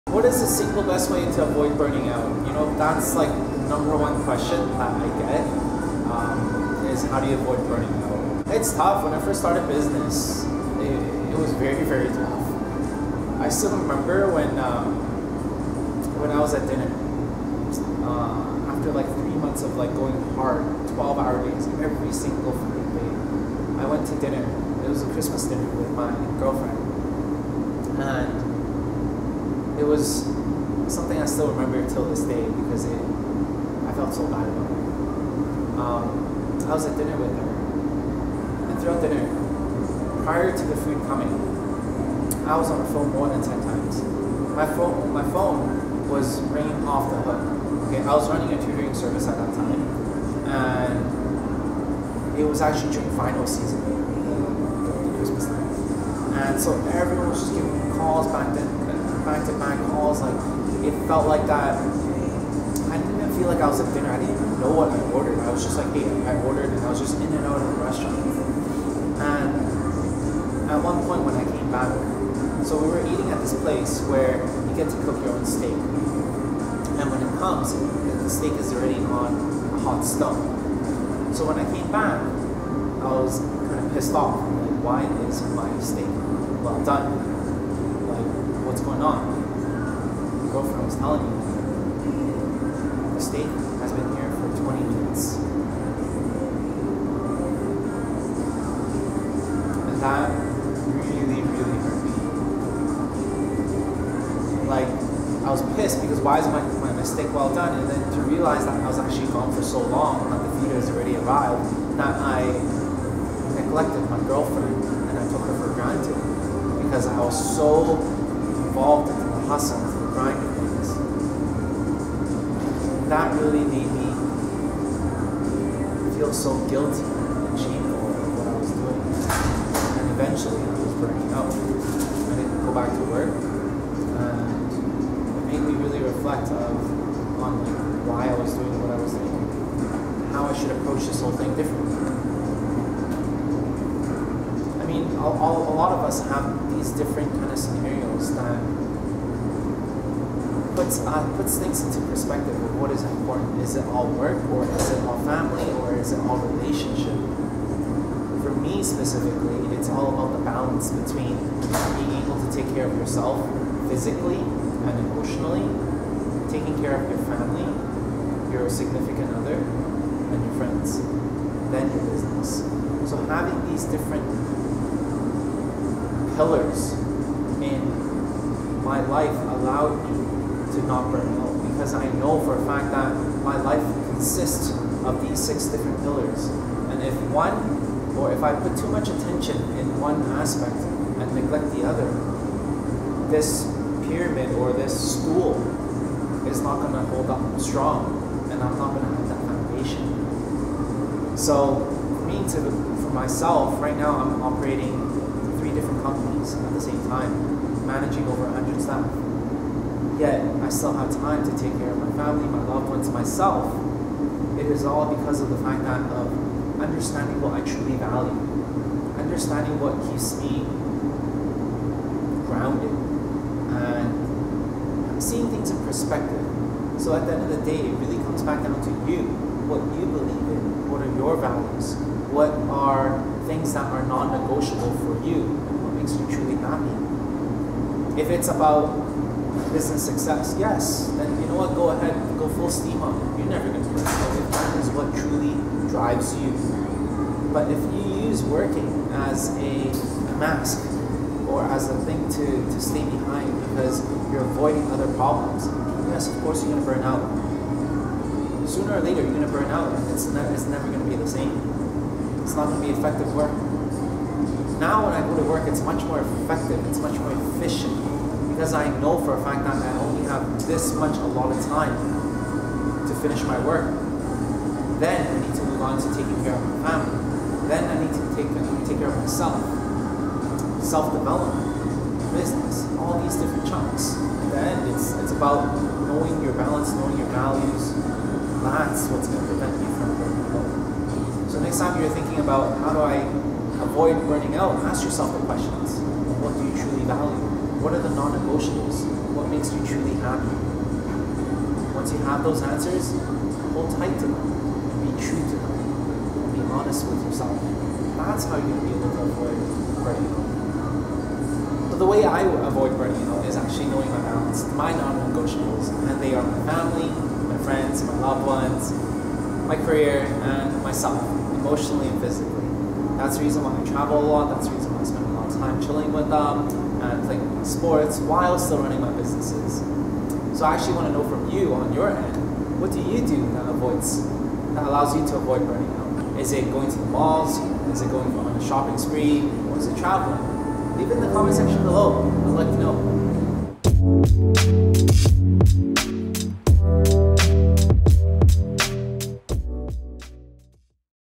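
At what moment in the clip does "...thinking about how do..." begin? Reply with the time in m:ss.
4:52.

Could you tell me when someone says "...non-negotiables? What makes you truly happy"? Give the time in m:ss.
4:58.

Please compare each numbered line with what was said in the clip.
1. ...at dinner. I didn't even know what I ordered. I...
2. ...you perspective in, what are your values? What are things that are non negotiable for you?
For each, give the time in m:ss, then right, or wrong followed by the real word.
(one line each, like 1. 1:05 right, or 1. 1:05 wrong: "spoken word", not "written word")
1. 1:03 right
2. 3:49 wrong: "believe", not "perspective".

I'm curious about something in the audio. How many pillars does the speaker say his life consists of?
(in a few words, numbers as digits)
6.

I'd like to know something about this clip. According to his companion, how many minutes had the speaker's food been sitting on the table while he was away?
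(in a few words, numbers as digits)
20.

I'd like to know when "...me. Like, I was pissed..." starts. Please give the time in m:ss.
1:44.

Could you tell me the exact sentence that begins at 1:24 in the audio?
Like, why is my steak well done?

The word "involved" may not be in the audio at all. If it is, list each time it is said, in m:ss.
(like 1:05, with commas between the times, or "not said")
1:58.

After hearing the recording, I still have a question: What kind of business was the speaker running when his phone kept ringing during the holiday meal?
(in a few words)
tutoring service.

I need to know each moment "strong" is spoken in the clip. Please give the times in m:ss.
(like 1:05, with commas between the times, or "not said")
3:17.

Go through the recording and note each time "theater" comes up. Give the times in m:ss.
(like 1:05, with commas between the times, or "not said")
1:50.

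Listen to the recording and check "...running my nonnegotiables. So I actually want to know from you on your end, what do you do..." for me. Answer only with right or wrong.
wrong.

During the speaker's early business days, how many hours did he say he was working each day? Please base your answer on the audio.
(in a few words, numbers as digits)
12.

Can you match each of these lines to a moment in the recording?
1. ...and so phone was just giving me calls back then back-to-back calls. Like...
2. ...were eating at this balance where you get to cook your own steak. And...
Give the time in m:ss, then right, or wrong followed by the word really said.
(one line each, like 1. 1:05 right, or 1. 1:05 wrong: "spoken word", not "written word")
1. 0:56 wrong: "everyone", not "phone"
2. 1:12 wrong: "place", not "balance".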